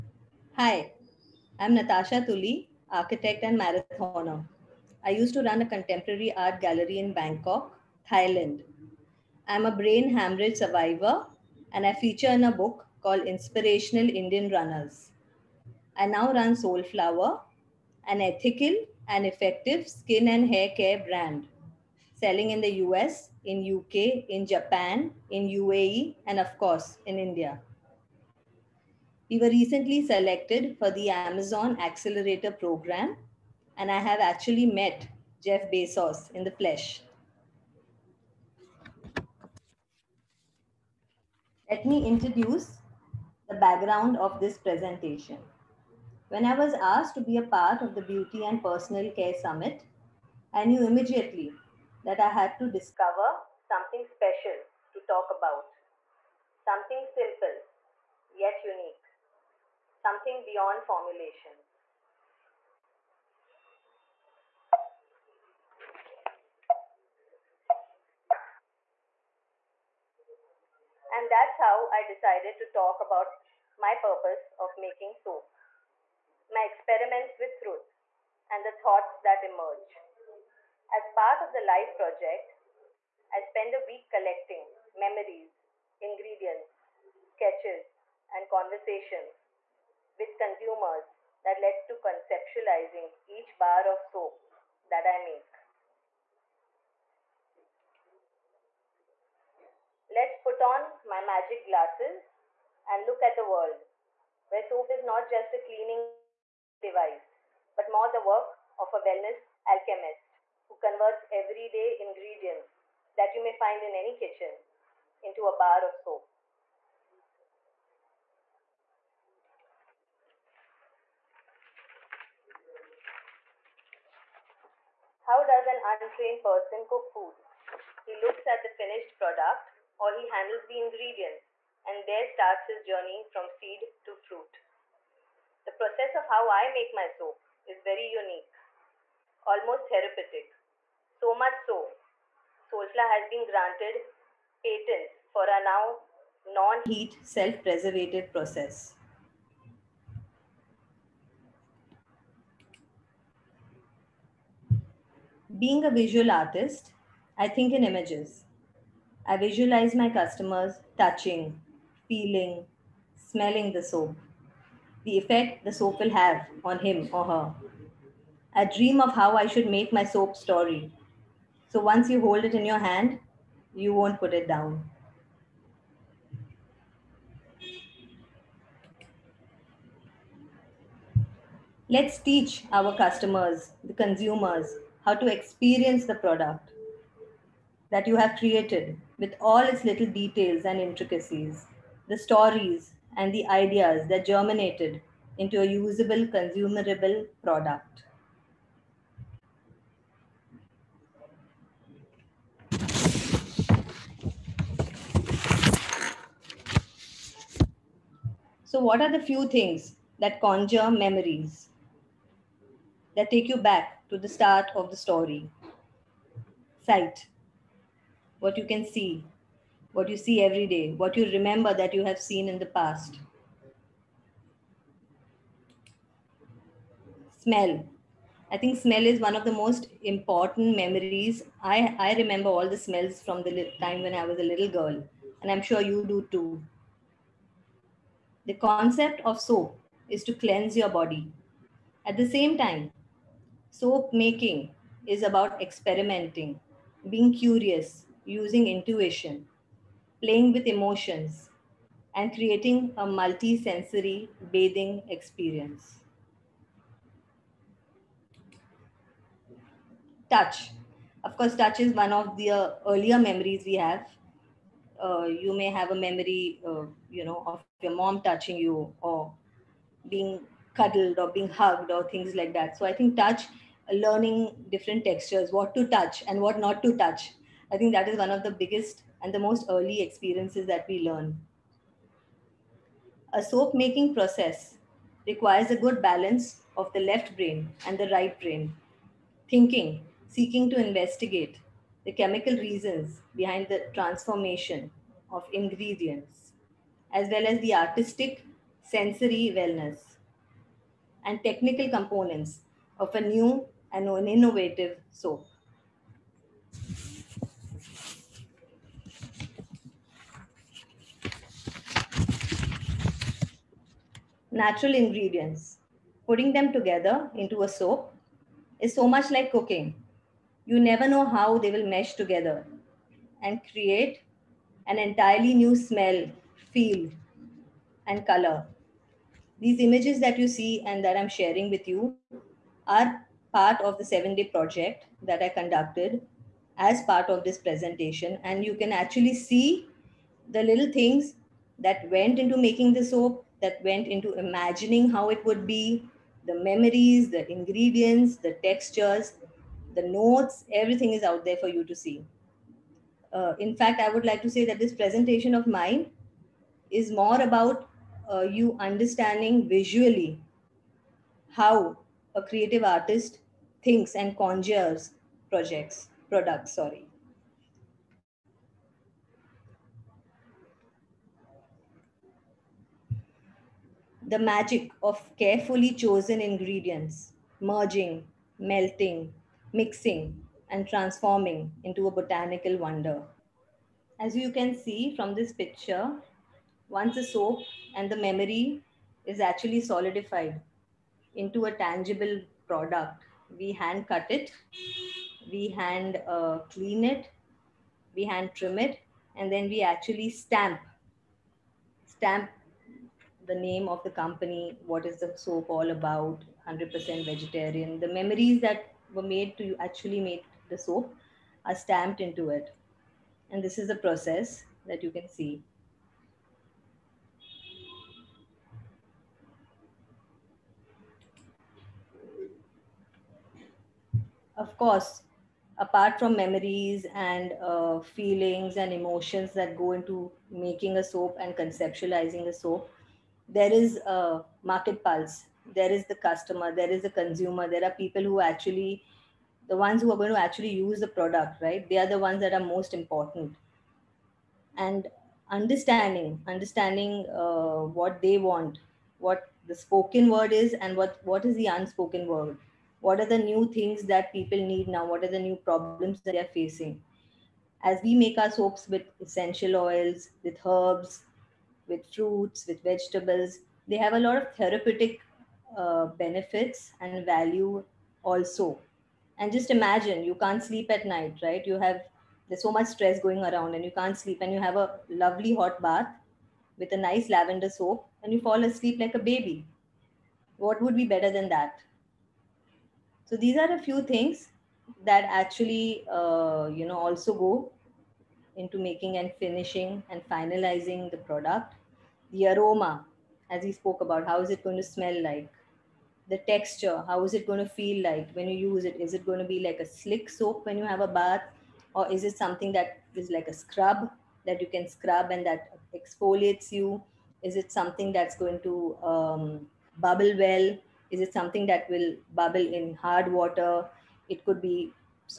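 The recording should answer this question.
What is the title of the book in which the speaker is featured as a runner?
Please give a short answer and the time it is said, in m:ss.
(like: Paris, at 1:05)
Inspirational Indian Runners, at 0:13.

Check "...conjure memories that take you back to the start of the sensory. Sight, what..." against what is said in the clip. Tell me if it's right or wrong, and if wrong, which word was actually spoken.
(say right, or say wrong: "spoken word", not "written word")
wrong: "story", not "sensory".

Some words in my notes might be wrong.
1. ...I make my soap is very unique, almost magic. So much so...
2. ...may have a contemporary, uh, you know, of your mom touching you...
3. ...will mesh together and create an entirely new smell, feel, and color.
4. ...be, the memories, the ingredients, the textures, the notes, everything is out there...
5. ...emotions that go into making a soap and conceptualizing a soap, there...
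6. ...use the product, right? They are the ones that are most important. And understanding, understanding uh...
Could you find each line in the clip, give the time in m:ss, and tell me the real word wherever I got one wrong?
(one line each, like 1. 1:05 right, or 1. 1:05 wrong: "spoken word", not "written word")
1. 2:16 wrong: "therapeutic", not "magic"
2. 4:25 wrong: "memory", not "contemporary"
3. 5:21 right
4. 5:45 right
5. 7:08 right
6. 7:20 right.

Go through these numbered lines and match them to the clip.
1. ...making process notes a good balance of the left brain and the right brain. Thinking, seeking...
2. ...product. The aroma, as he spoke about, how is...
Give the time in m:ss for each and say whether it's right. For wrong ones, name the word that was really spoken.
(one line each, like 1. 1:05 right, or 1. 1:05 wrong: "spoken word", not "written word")
1. 4:43 wrong: "requires", not "notes"
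2. 8:11 right.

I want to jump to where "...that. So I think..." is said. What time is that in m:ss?
4:32.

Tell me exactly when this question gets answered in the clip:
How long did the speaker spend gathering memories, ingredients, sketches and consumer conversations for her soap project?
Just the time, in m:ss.
1:23.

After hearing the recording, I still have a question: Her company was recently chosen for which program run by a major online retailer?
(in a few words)
Amazon Accelerator Program.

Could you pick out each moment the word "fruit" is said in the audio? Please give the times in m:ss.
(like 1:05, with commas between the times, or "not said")
2:14, 7:42.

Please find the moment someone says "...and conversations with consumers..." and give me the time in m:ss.
1:28.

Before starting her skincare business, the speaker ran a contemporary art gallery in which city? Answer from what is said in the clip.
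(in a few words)
Bangkok.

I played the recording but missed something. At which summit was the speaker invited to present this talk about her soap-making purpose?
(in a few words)
Beauty and Personal Care Summit.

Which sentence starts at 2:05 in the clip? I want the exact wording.
How does an untrained person cook food?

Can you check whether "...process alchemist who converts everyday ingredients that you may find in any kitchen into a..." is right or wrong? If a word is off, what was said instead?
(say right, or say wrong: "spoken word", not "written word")
wrong: "wellness", not "process".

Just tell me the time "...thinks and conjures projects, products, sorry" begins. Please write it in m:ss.
6:03.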